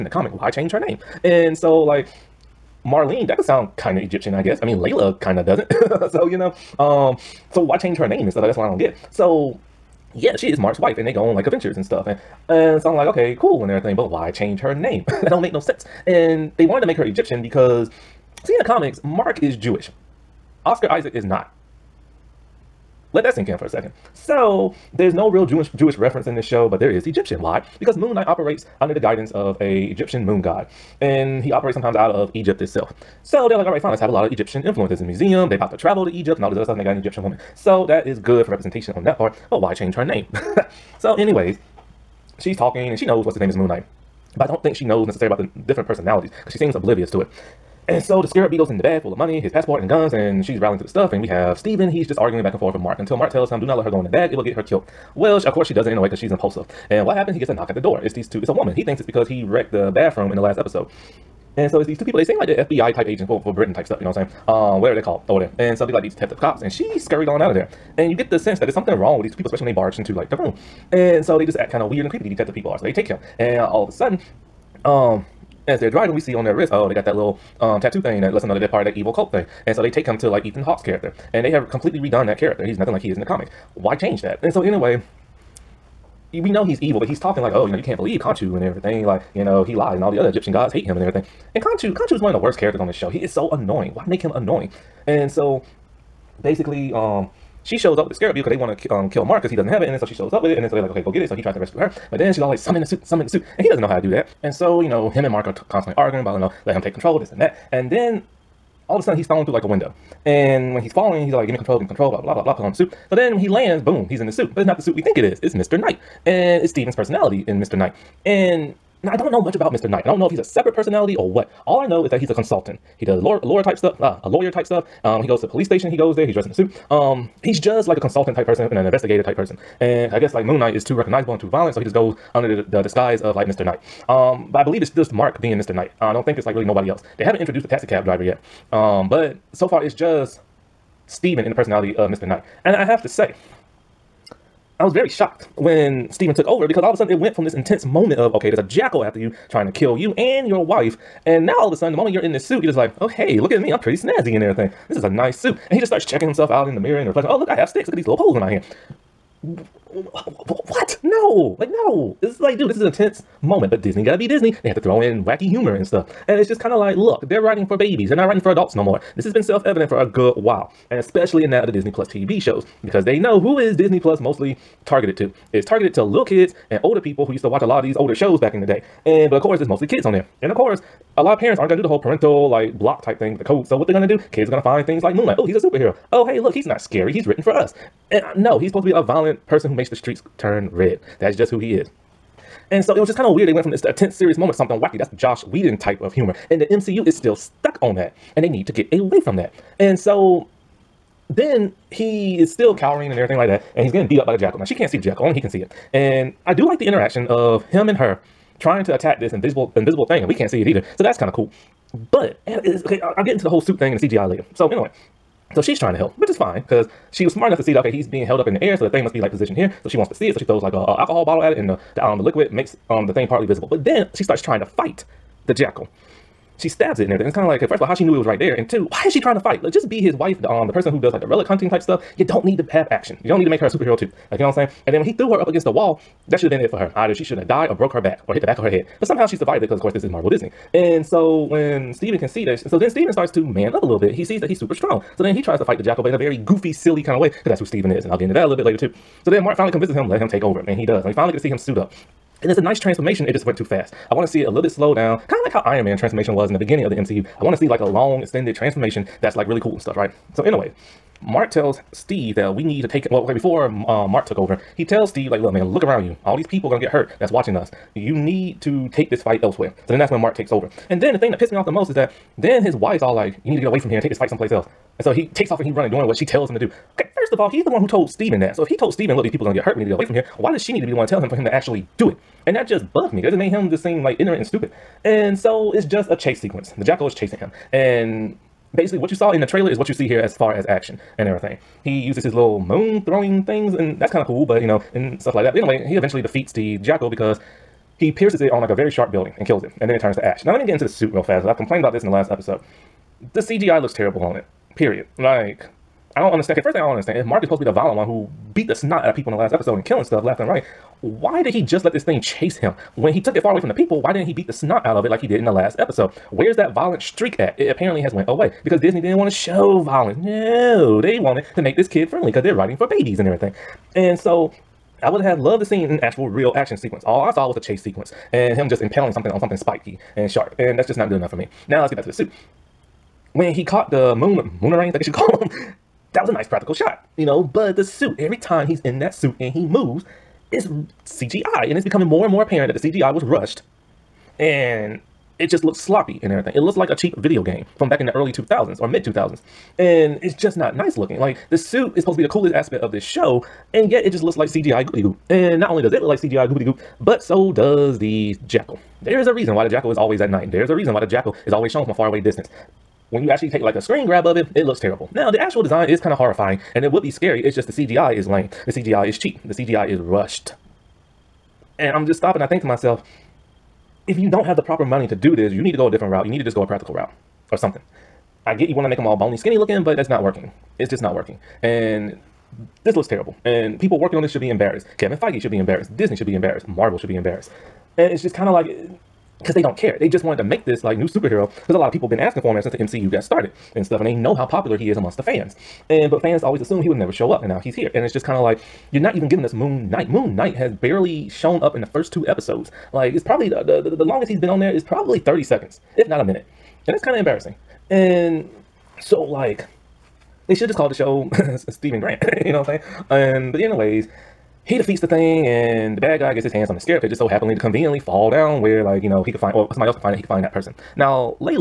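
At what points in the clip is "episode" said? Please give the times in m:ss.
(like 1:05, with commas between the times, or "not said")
1:00, 5:02, 5:09, 5:15, 6:42.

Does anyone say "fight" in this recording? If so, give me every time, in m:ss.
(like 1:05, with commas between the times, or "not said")
3:44, 3:49, 4:05, 4:29, 4:34.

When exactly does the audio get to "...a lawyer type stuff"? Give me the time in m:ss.
2:04.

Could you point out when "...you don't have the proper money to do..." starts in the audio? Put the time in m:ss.
6:14.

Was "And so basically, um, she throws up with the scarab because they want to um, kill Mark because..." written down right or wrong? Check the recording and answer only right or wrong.
wrong.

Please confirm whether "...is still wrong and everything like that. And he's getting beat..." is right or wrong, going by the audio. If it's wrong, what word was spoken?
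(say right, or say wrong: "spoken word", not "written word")
wrong: "cowering", not "wrong".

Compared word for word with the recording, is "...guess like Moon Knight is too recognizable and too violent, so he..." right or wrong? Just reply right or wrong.
right.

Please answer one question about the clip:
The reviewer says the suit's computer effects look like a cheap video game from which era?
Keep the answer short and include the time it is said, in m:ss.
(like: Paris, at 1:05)
early-to-mid 2000s, at 5:48.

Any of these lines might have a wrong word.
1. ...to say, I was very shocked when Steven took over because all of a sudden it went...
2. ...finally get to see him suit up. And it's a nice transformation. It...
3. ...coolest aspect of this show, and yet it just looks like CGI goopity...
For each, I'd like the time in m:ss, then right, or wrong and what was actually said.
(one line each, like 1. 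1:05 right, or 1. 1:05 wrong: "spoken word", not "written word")
1. 2:23 right
2. 4:11 right
3. 5:52 right.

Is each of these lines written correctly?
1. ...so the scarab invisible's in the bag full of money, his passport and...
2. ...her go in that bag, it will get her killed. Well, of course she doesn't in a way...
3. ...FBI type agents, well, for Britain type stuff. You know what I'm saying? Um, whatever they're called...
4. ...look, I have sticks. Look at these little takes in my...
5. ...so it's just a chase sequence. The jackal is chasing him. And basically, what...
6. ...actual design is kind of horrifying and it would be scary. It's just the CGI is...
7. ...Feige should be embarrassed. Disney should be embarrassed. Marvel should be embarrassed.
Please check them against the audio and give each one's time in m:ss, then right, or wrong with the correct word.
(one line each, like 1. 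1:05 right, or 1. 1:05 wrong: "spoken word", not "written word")
1. 0:48 wrong: "beetle", not "invisible"
2. 0:53 right
3. 1:02 right
4. 2:37 wrong: "poles", not "takes"
5. 4:45 right
6. 6:05 right
7. 6:25 right.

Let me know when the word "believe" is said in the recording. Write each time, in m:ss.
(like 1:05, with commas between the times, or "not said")
1:27, 2:14.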